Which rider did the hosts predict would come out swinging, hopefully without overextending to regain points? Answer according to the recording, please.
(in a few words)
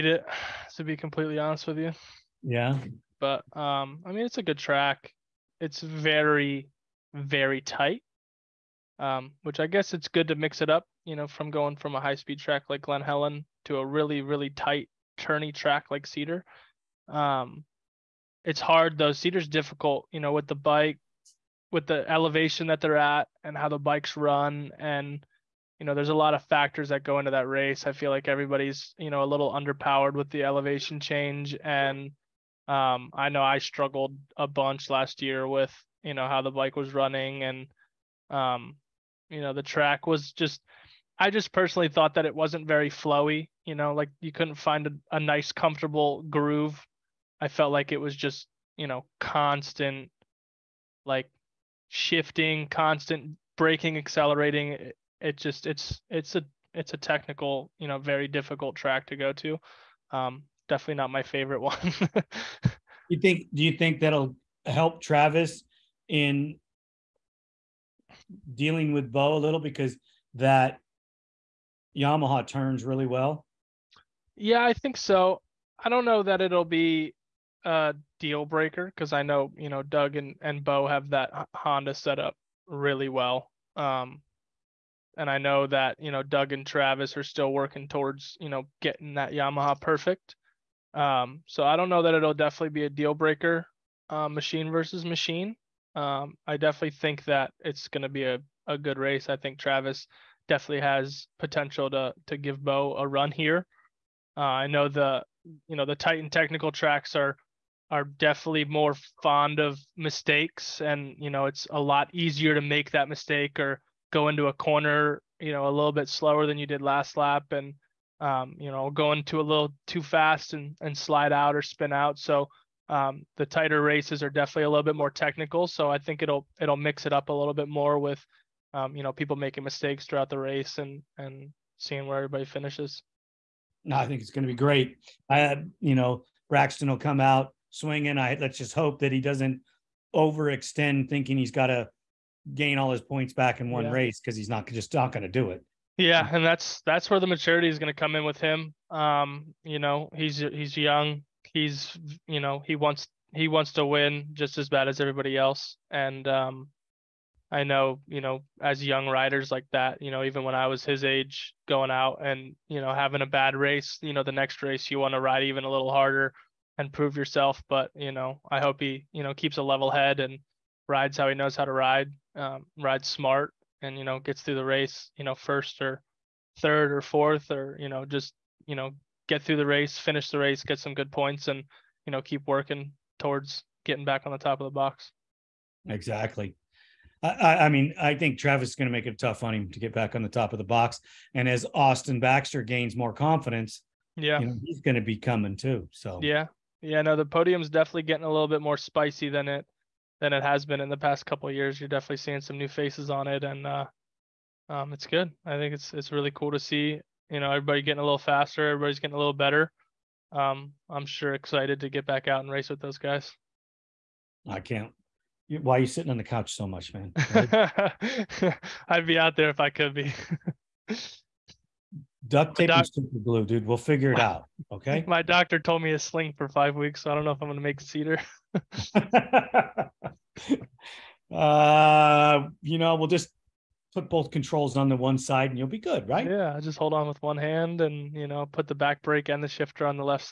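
Braxton.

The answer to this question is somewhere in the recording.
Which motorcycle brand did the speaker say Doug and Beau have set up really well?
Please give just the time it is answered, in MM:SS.
01:21.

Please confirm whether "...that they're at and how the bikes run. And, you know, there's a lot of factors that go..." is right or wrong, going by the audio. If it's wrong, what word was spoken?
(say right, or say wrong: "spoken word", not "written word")
right.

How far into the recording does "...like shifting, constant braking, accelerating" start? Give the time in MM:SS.
00:51.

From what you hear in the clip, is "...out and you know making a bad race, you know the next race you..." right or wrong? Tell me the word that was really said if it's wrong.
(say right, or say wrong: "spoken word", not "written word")
wrong: "having", not "making".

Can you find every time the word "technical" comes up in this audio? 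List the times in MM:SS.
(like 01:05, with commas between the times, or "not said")
00:56, 01:46, 02:05.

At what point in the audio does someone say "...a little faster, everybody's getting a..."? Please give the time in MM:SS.
03:27.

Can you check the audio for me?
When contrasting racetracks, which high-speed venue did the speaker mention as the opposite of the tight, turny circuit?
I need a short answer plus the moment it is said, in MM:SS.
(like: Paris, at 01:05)
Glen Helen, at 00:12.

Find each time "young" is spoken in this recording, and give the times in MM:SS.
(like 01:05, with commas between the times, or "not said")
02:30, 02:38.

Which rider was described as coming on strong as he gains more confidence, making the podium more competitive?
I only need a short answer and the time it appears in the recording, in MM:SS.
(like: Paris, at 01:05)
Austin Baxter, at 03:11.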